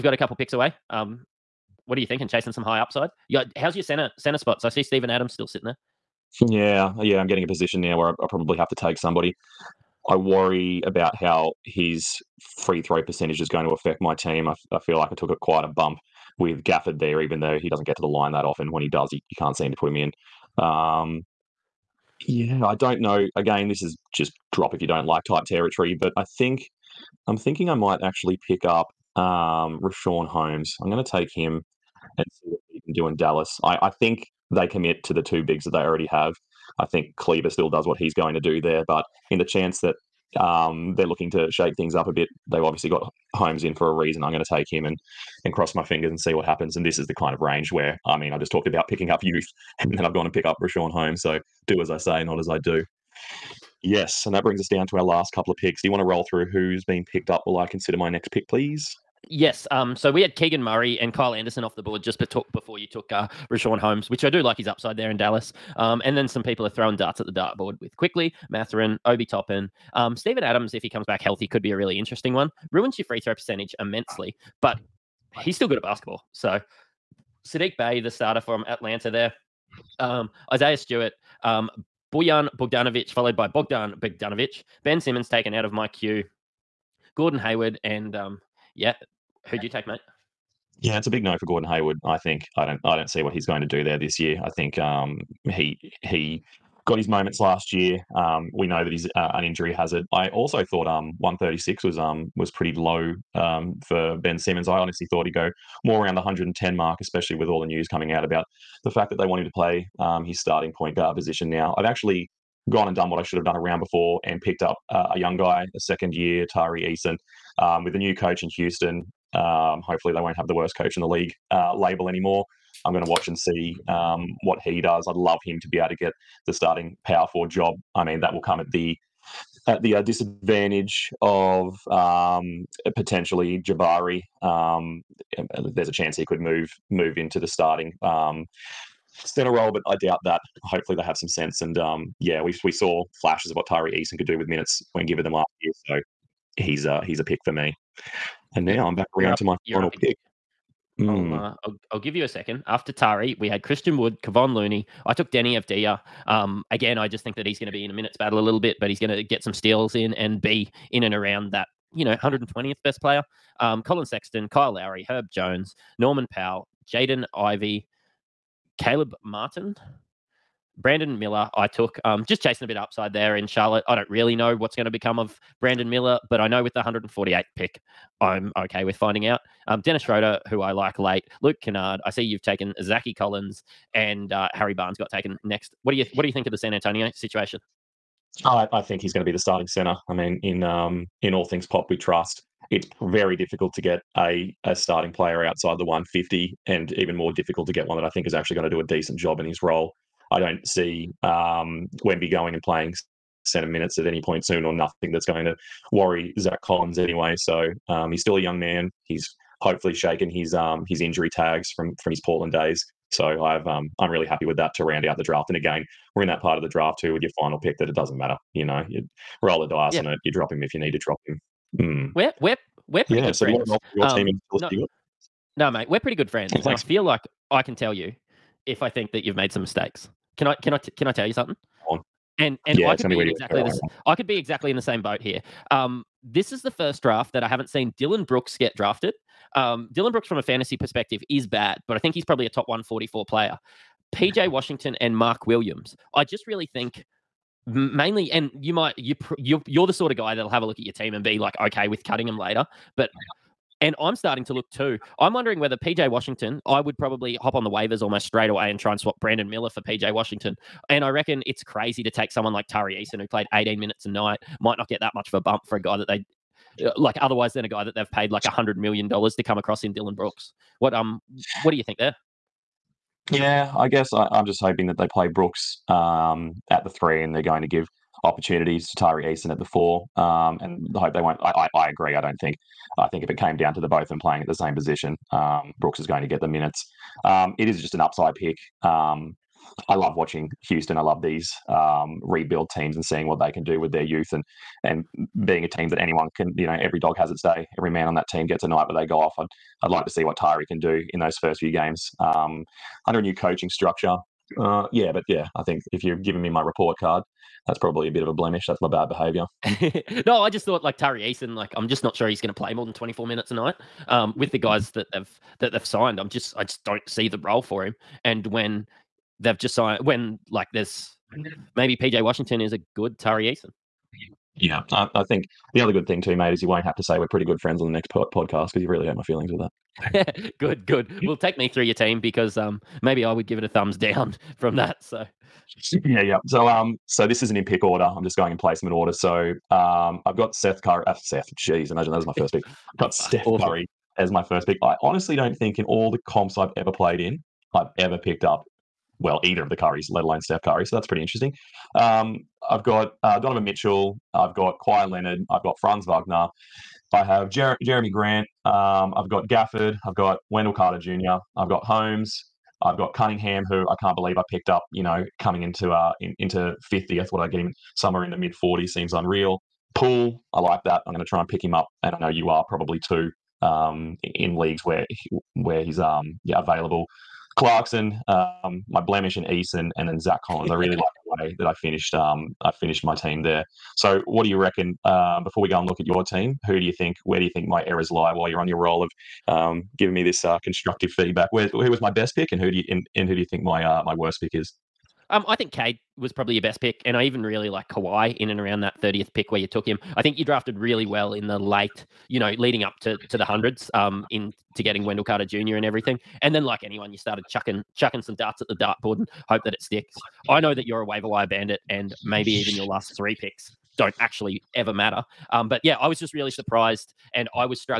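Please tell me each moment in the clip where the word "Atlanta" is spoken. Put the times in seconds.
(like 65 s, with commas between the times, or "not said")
78 s.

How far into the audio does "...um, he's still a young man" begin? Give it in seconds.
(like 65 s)
207 s.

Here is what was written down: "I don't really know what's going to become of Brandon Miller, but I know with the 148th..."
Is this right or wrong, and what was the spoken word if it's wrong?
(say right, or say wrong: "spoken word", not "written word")
right.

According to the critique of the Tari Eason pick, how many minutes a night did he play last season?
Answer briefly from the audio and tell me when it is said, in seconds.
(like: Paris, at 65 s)
18, at 263 s.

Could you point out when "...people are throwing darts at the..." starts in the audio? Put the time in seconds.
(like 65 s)
66 s.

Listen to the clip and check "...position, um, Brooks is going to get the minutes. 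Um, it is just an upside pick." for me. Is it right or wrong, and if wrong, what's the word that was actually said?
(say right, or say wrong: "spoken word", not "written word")
right.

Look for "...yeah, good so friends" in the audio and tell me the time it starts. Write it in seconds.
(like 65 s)
223 s.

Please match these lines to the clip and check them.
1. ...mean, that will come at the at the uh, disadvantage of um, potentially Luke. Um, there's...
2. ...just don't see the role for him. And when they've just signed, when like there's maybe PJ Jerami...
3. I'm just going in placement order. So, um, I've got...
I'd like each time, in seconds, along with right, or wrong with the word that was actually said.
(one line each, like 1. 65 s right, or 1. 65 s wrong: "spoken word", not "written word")
1. 128 s wrong: "Jabari", not "Luke"
2. 316 s wrong: "Washington", not "Jerami"
3. 338 s right.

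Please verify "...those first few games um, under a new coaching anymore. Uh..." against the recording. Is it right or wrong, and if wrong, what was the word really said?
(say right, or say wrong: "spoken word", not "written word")
wrong: "structure", not "anymore".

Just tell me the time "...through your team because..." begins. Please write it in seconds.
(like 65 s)
331 s.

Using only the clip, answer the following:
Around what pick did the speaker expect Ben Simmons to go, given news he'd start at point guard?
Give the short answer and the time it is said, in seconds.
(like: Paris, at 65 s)
110, at 106 s.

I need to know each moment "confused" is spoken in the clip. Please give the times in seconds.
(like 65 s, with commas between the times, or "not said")
not said.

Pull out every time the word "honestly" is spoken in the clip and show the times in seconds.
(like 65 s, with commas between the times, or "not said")
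104 s, 345 s.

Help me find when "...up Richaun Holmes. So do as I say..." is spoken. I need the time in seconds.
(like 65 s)
50 s.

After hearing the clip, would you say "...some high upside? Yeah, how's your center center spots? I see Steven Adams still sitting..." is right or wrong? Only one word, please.
right.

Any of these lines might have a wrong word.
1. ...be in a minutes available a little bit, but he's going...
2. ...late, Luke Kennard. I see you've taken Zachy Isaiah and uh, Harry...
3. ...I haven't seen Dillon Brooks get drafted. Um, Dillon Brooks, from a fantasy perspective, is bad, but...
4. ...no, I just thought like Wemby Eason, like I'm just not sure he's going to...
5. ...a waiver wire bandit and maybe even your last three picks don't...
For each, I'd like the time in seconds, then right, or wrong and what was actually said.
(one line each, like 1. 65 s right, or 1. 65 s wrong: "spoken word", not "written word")
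1. 157 s wrong: "battle", not "available"
2. 180 s wrong: "Collins", not "Isaiah"
3. 237 s right
4. 310 s wrong: "Tari", not "Wemby"
5. 411 s right.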